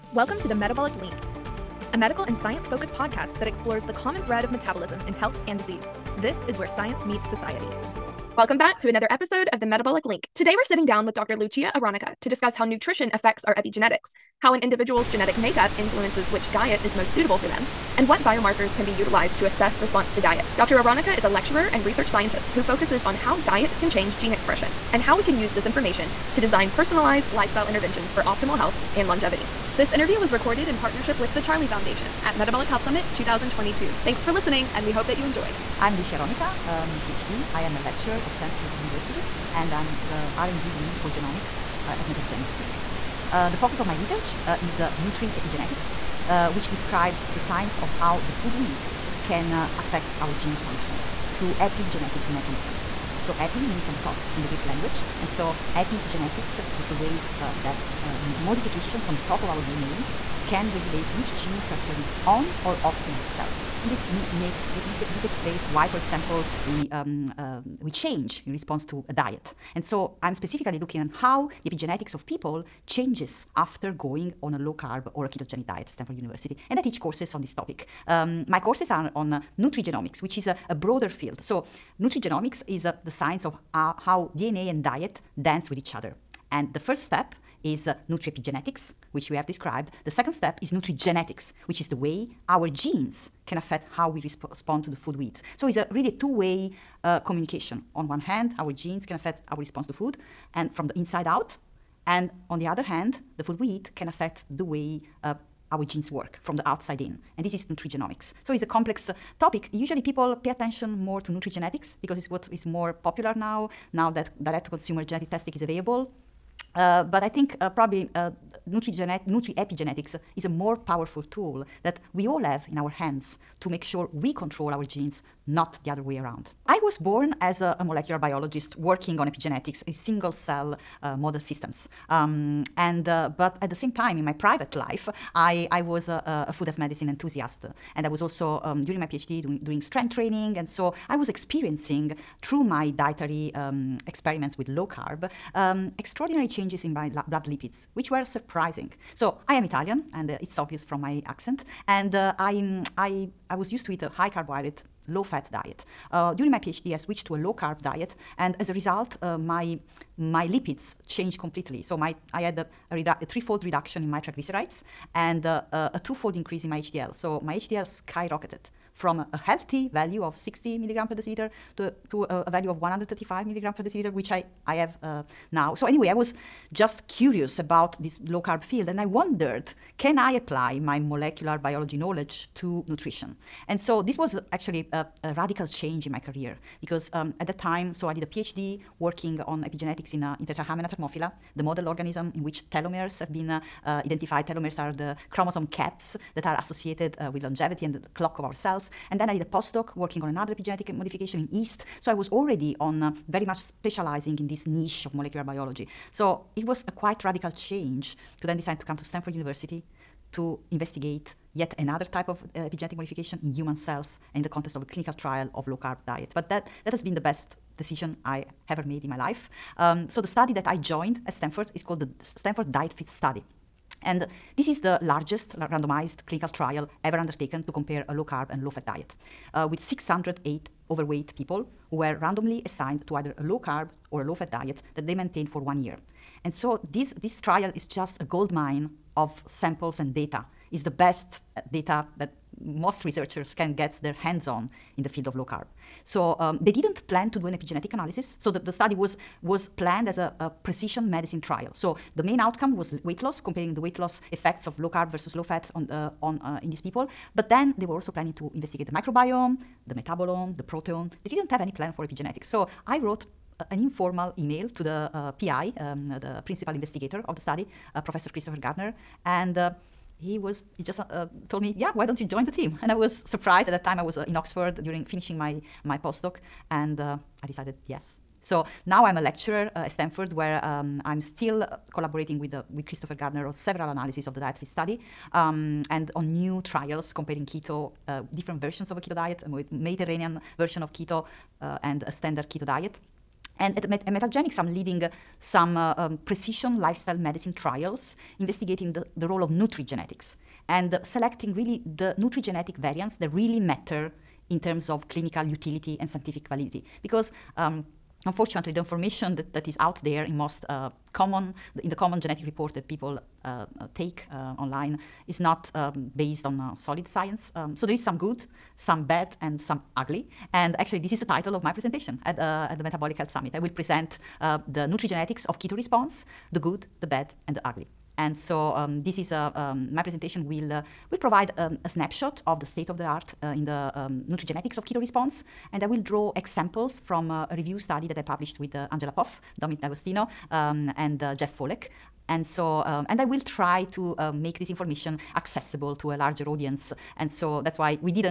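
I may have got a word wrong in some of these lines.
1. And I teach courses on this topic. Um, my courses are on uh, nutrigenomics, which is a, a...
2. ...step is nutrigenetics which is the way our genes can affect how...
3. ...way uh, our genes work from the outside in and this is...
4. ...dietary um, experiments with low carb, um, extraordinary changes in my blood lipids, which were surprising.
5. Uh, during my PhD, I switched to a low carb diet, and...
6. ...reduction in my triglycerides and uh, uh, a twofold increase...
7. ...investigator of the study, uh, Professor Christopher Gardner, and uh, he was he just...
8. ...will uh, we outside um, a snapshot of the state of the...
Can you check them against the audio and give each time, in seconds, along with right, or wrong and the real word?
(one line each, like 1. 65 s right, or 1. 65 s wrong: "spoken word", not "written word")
1. 76 s right
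2. 90 s right
3. 104 s right
4. 142 s right
5. 156 s right
6. 163 s right
7. 266 s right
8. 330 s wrong: "provide", not "outside".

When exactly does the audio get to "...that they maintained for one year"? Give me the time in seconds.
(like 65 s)
234 s.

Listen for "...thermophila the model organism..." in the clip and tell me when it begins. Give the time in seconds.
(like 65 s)
190 s.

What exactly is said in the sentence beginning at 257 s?
But then they were also planning to investigate the microbiome, the metabolome, the proteome.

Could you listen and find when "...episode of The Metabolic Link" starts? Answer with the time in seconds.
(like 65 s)
9 s.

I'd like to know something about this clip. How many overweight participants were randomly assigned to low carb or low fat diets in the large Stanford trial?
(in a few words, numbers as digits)
608.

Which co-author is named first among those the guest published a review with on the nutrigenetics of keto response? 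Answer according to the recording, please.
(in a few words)
Angela Poff.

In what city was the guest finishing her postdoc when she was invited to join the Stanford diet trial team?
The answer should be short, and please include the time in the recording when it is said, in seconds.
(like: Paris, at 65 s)
Oxford, at 274 s.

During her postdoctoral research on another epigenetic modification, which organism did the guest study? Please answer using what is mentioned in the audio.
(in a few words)
Yeast.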